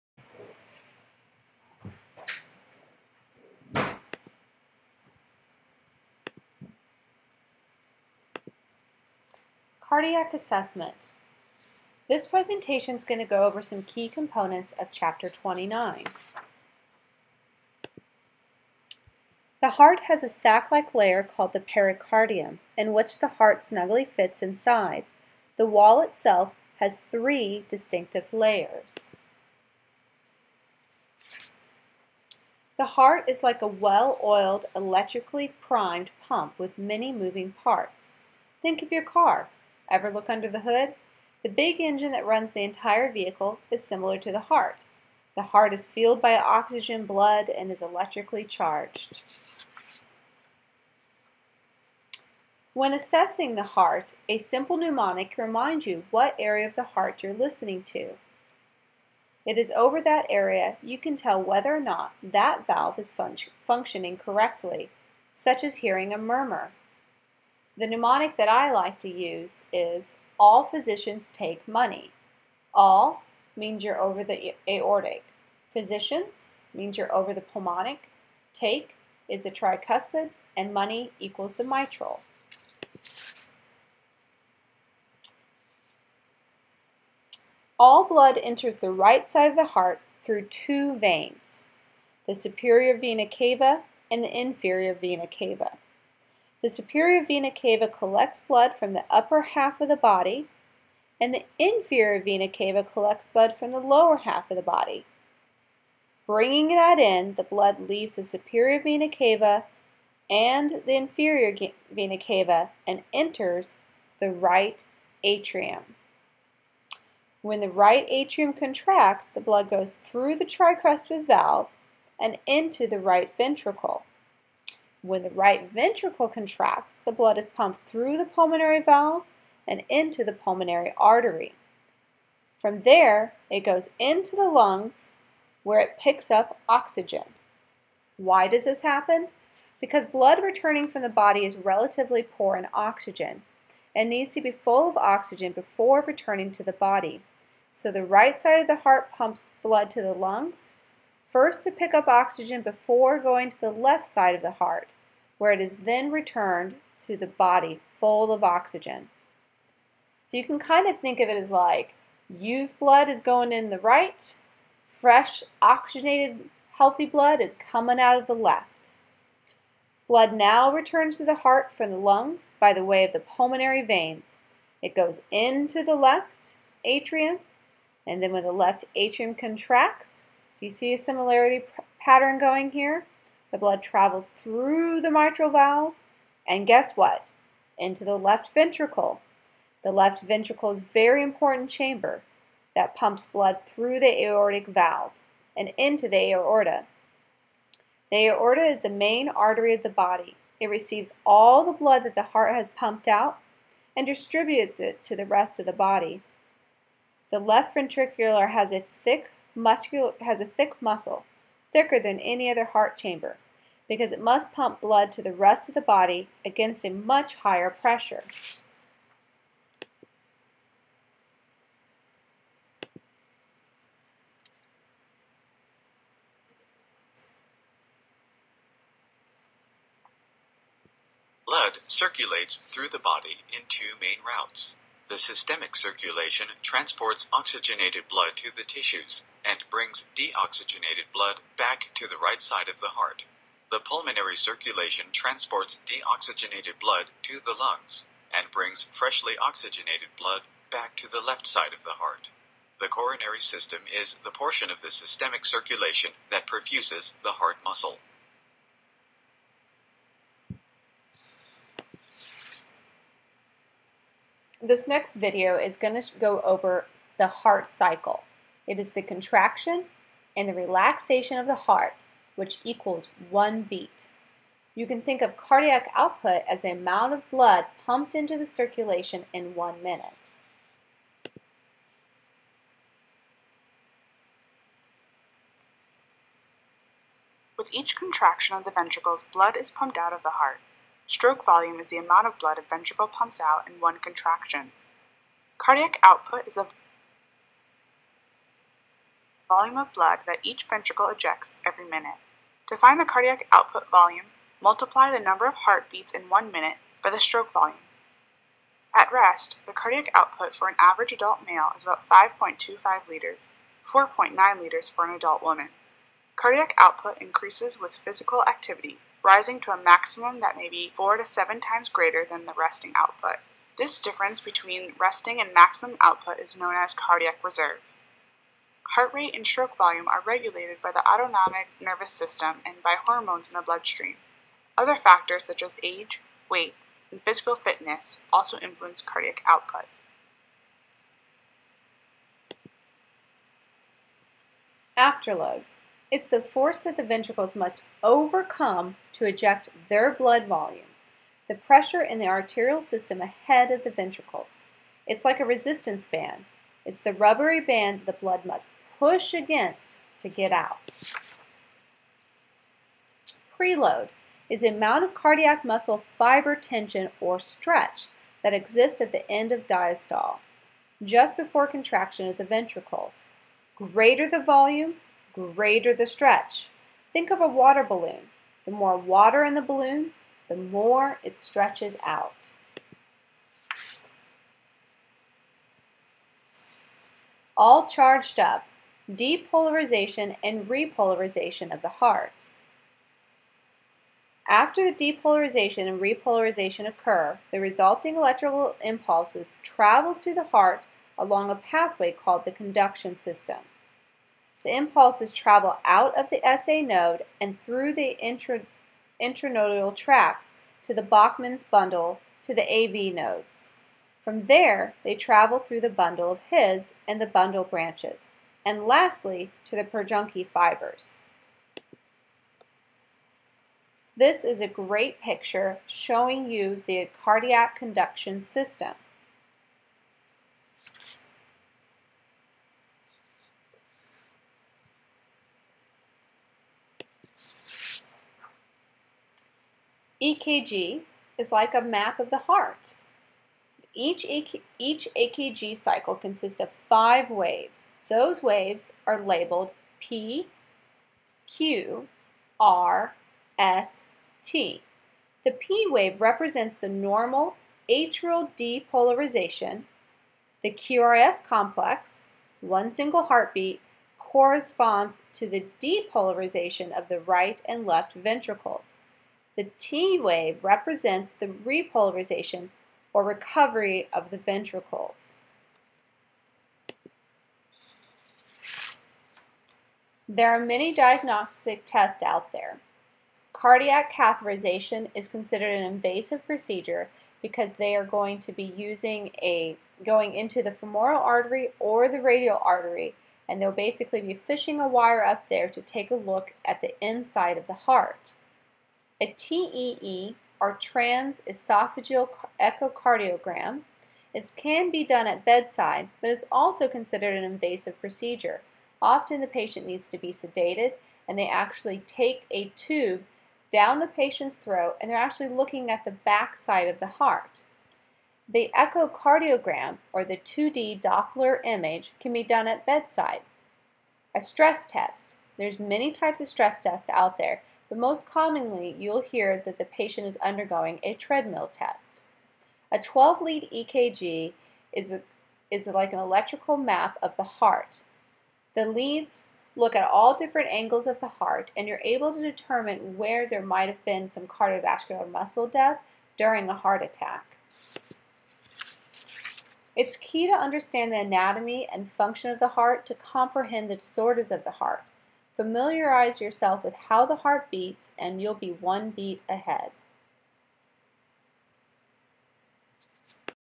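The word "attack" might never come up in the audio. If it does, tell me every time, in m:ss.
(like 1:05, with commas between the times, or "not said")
9:07.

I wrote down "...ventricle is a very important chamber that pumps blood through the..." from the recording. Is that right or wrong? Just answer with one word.
right.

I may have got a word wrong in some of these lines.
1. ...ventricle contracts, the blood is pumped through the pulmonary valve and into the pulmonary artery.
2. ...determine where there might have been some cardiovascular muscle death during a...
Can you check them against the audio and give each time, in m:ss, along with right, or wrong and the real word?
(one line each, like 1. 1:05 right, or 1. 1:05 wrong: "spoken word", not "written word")
1. 2:05 right
2. 9:02 right.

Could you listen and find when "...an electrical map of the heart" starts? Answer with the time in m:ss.
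8:56.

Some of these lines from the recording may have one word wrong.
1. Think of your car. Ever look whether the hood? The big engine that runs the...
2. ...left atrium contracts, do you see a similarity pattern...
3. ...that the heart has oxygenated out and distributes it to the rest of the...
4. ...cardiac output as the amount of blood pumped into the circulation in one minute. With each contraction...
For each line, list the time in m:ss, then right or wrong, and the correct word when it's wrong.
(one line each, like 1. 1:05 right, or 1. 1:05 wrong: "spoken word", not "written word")
1. 0:38 wrong: "under", not "whether"
2. 2:58 right
3. 3:22 wrong: "pumped", not "oxygenated"
4. 4:35 right.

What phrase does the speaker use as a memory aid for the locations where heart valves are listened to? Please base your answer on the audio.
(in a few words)
all physicians take money.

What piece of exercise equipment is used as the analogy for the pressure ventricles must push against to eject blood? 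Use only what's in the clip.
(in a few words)
resistance band.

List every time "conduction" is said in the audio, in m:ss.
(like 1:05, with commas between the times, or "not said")
6:42, 7:07.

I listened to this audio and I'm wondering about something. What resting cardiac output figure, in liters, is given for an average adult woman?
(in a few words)
4.9 liters.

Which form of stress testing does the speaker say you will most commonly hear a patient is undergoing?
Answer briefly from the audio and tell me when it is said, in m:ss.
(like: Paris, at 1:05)
treadmill test, at 8:51.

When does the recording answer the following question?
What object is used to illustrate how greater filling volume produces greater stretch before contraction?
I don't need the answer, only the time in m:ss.
6:17.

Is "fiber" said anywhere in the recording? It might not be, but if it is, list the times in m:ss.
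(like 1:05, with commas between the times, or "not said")
6:06, 7:00.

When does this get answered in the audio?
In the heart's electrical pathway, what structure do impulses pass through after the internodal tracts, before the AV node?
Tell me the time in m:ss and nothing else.
6:51.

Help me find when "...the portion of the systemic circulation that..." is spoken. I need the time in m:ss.
4:14.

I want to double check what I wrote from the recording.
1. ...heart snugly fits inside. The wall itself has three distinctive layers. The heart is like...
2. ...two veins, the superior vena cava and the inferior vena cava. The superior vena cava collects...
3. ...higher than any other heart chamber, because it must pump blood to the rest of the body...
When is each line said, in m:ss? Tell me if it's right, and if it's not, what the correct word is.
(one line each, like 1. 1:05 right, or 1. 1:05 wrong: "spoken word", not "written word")
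1. 0:23 right
2. 1:30 right
3. 3:31 wrong: "thicker", not "higher".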